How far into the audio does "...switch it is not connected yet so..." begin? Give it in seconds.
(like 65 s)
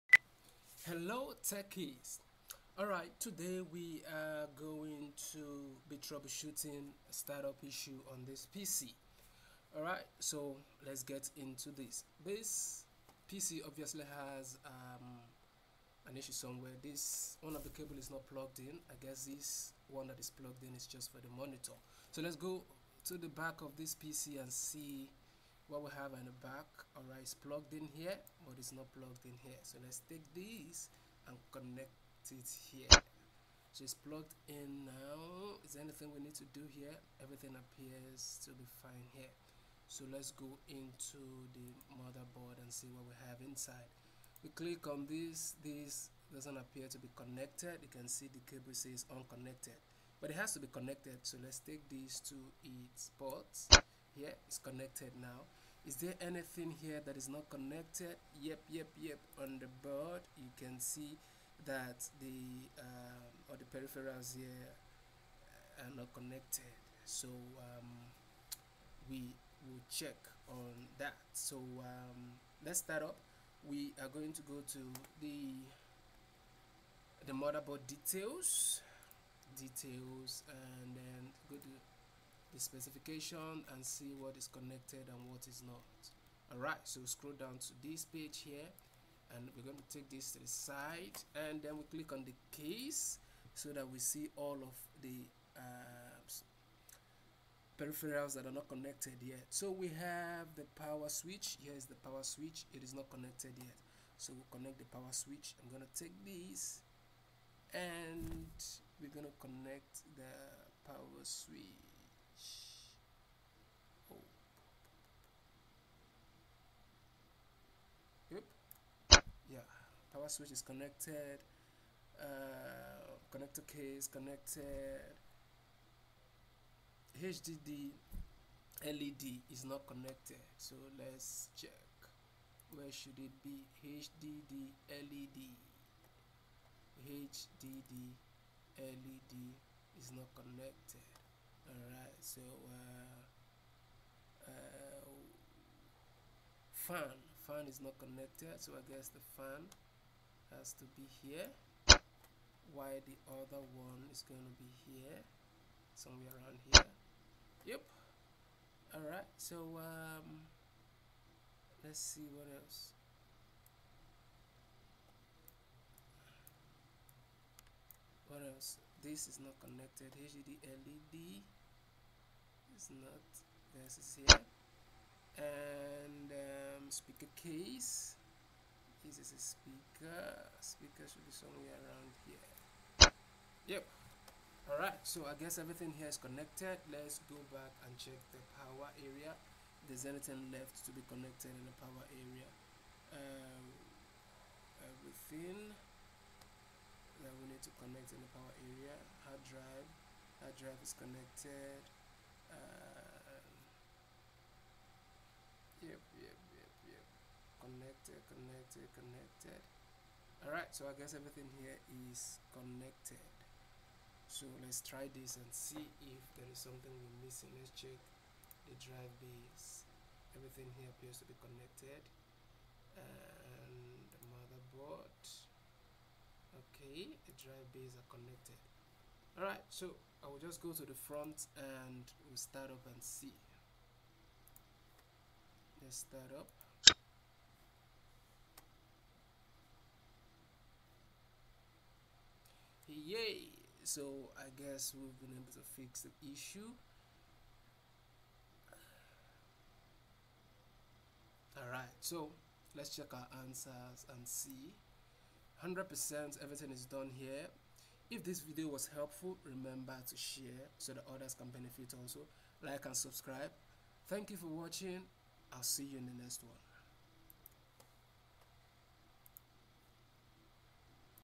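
102 s.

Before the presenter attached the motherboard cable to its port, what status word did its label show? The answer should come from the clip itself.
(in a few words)
unconnected.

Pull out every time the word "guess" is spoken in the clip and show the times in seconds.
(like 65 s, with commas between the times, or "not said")
18 s, 148 s, 185 s, 210 s, 244 s.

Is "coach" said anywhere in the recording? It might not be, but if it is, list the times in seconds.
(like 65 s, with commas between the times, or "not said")
not said.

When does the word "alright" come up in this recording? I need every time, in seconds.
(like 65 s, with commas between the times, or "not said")
2 s, 9 s, 86 s, 141 s, 210 s, 229 s, 251 s.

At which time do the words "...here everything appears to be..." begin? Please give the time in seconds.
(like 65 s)
36 s.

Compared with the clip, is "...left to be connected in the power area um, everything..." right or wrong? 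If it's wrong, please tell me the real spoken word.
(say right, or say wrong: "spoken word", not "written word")
right.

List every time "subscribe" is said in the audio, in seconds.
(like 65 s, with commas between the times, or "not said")
262 s.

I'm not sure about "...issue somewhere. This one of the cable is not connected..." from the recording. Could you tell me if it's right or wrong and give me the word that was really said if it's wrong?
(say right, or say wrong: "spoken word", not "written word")
wrong: "plugged", not "connected".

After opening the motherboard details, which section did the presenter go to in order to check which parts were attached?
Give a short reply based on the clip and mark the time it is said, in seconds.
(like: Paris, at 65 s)
specification, at 82 s.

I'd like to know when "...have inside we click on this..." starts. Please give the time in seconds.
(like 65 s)
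43 s.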